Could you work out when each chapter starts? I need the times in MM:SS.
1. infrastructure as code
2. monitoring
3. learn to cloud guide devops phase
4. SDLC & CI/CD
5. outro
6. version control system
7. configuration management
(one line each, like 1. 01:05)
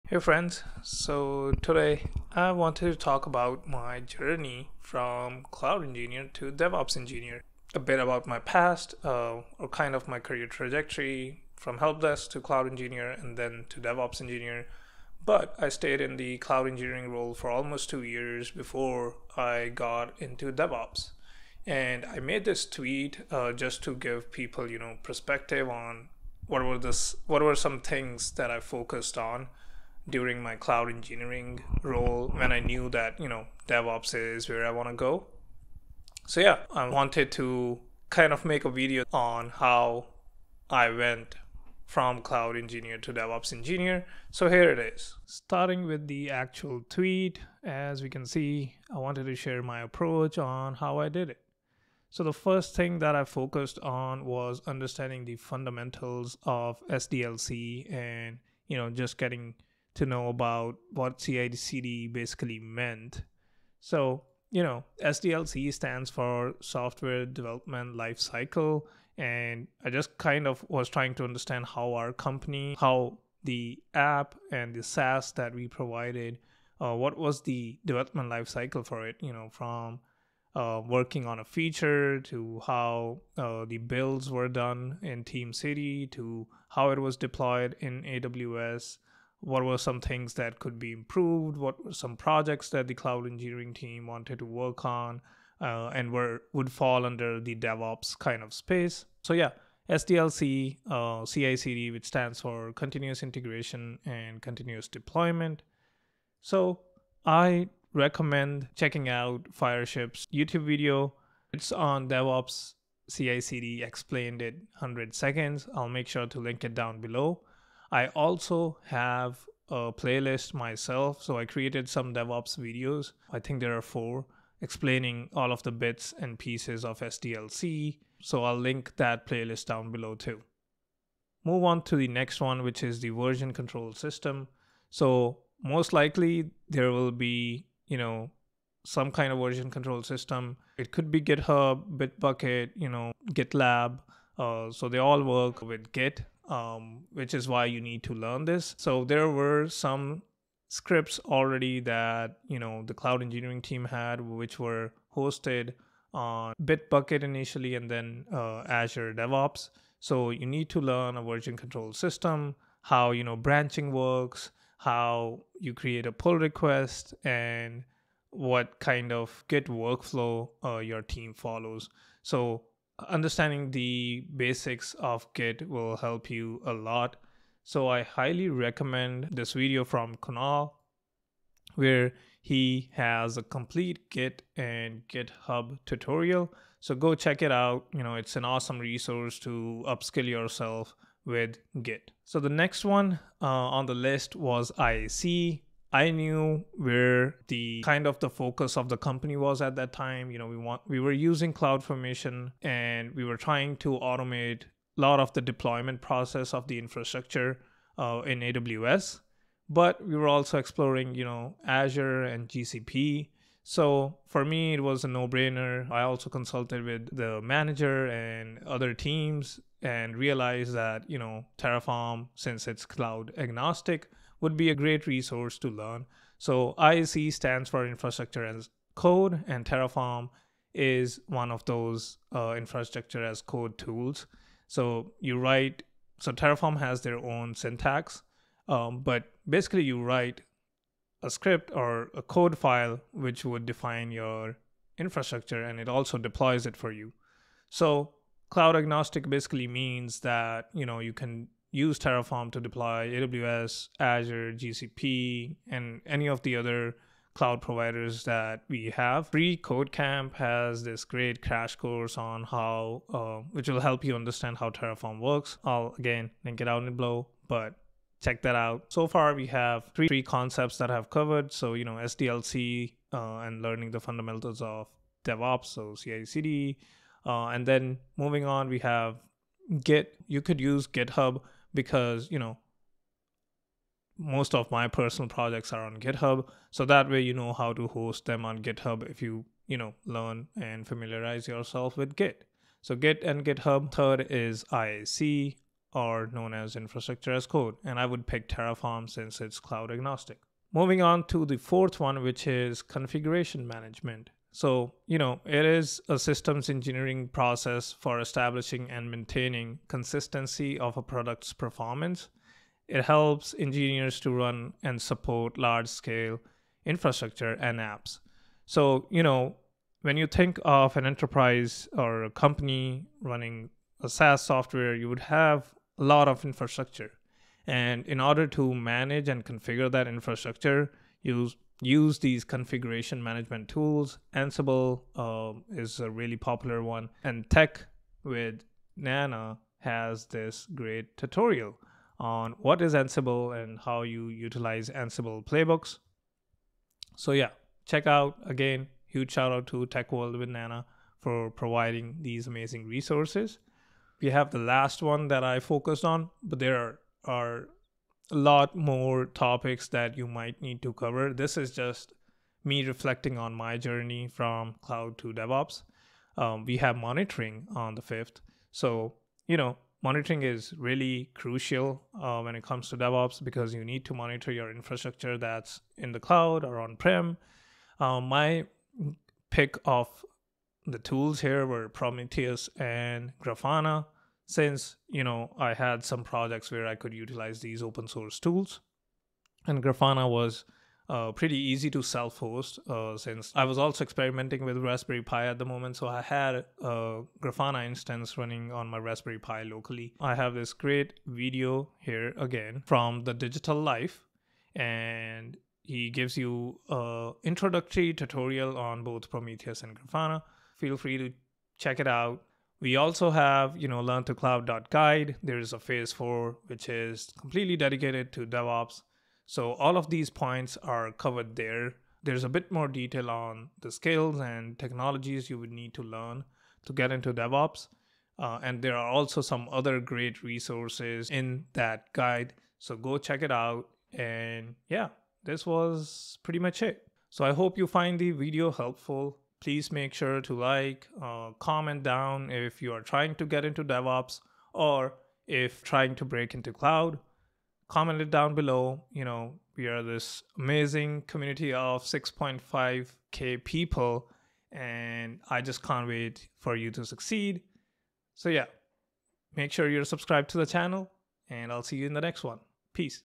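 1. 03:11
2. 05:54
3. 06:54
4. 00:45
5. 07:16
6. 02:11
7. 05:00.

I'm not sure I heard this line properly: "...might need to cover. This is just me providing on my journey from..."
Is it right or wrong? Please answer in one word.
wrong.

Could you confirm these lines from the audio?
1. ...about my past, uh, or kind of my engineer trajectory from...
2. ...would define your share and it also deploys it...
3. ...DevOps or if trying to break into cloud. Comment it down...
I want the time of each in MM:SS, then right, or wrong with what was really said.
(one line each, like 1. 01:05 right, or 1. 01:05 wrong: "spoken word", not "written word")
1. 00:07 wrong: "career", not "engineer"
2. 04:03 wrong: "infrastructure", not "share"
3. 07:23 right.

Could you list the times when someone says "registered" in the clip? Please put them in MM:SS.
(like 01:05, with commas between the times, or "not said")
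not said.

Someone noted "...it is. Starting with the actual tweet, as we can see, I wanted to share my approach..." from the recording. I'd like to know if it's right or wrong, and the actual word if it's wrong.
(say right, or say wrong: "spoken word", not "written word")
right.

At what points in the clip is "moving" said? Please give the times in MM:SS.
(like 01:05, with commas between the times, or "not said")
04:38, 05:00.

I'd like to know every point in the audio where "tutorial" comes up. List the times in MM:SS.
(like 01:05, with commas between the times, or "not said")
03:05, 05:41, 06:48.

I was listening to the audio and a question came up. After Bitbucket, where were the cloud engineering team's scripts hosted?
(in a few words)
Azure DevOps.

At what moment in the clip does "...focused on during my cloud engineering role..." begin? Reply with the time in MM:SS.
00:28.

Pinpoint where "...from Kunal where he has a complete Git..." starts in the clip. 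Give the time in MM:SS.
02:59.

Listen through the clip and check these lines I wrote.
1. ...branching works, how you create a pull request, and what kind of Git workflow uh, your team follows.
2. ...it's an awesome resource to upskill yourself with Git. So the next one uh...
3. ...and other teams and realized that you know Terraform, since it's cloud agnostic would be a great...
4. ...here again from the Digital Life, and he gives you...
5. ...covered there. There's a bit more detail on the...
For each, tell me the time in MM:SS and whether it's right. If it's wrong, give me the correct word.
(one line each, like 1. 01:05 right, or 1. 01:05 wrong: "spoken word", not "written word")
1. 02:43 right
2. 03:08 right
3. 03:38 right
4. 06:41 right
5. 07:01 right.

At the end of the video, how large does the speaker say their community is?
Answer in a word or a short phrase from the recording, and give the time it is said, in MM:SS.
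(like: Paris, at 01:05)
6.5K, at 07:32.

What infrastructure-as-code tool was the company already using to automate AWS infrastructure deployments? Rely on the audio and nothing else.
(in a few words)
CloudFormation.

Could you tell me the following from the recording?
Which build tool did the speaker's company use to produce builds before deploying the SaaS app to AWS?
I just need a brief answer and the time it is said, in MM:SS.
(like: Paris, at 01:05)
TeamCity, at 01:25.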